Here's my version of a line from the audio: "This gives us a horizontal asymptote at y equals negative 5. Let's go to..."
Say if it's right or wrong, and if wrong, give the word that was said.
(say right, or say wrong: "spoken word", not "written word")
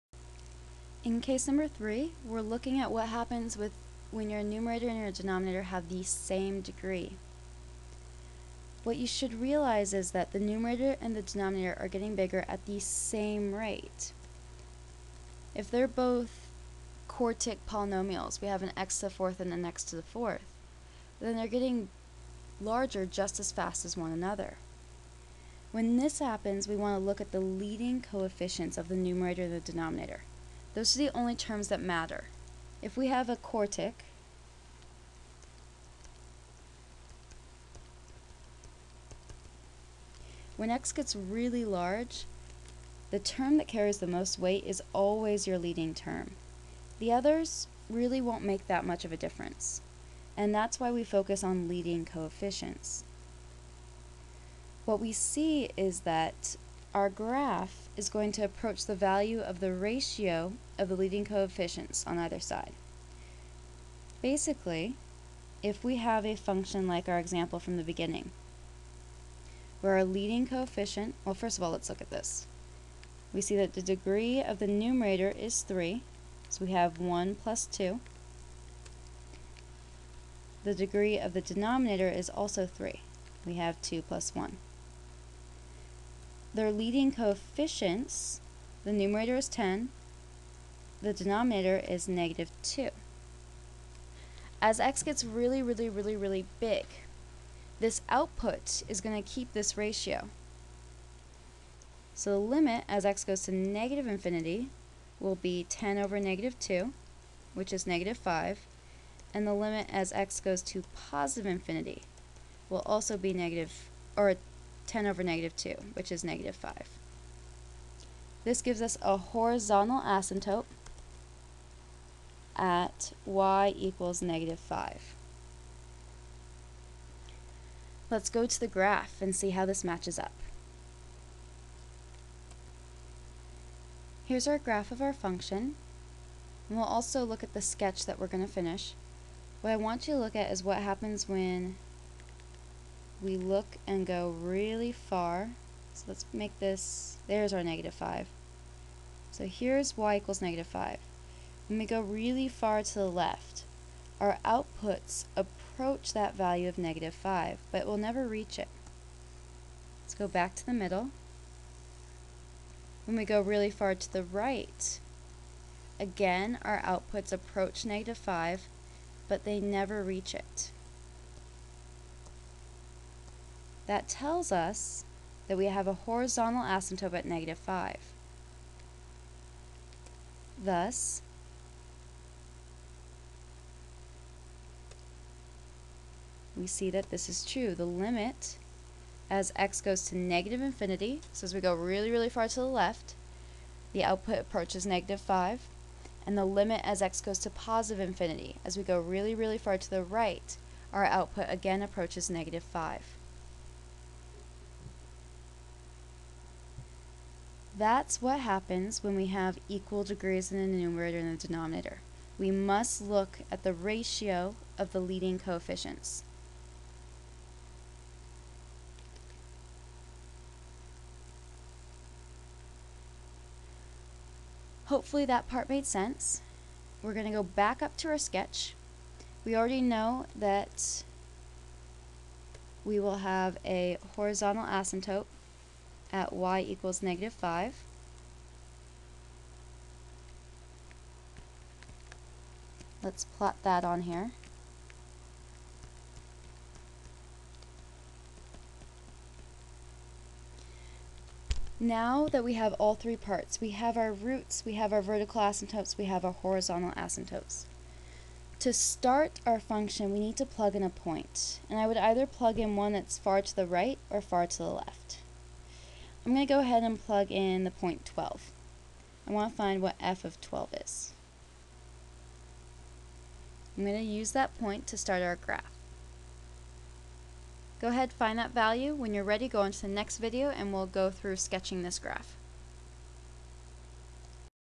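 right.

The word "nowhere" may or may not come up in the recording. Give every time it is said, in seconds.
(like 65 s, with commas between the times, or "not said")
not said.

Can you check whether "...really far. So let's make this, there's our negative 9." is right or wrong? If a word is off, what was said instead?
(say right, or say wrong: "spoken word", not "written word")
wrong: "5", not "9".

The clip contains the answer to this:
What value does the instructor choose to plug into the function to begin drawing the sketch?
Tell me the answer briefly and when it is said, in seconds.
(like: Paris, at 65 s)
12, at 267 s.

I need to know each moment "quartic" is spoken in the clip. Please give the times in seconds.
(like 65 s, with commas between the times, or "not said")
17 s, 33 s.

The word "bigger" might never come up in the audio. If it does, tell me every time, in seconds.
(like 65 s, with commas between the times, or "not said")
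12 s.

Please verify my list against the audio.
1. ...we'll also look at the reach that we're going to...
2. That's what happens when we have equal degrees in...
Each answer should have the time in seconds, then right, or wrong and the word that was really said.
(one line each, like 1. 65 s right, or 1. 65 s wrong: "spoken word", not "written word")
1. 136 s wrong: "sketch", not "reach"
2. 207 s right.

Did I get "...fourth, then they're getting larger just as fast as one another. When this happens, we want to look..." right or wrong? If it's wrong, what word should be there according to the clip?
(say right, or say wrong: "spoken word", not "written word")
right.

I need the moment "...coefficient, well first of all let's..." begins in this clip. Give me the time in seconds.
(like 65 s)
70 s.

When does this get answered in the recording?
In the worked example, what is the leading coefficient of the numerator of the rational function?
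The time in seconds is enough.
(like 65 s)
88 s.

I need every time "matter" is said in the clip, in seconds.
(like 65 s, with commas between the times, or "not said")
31 s.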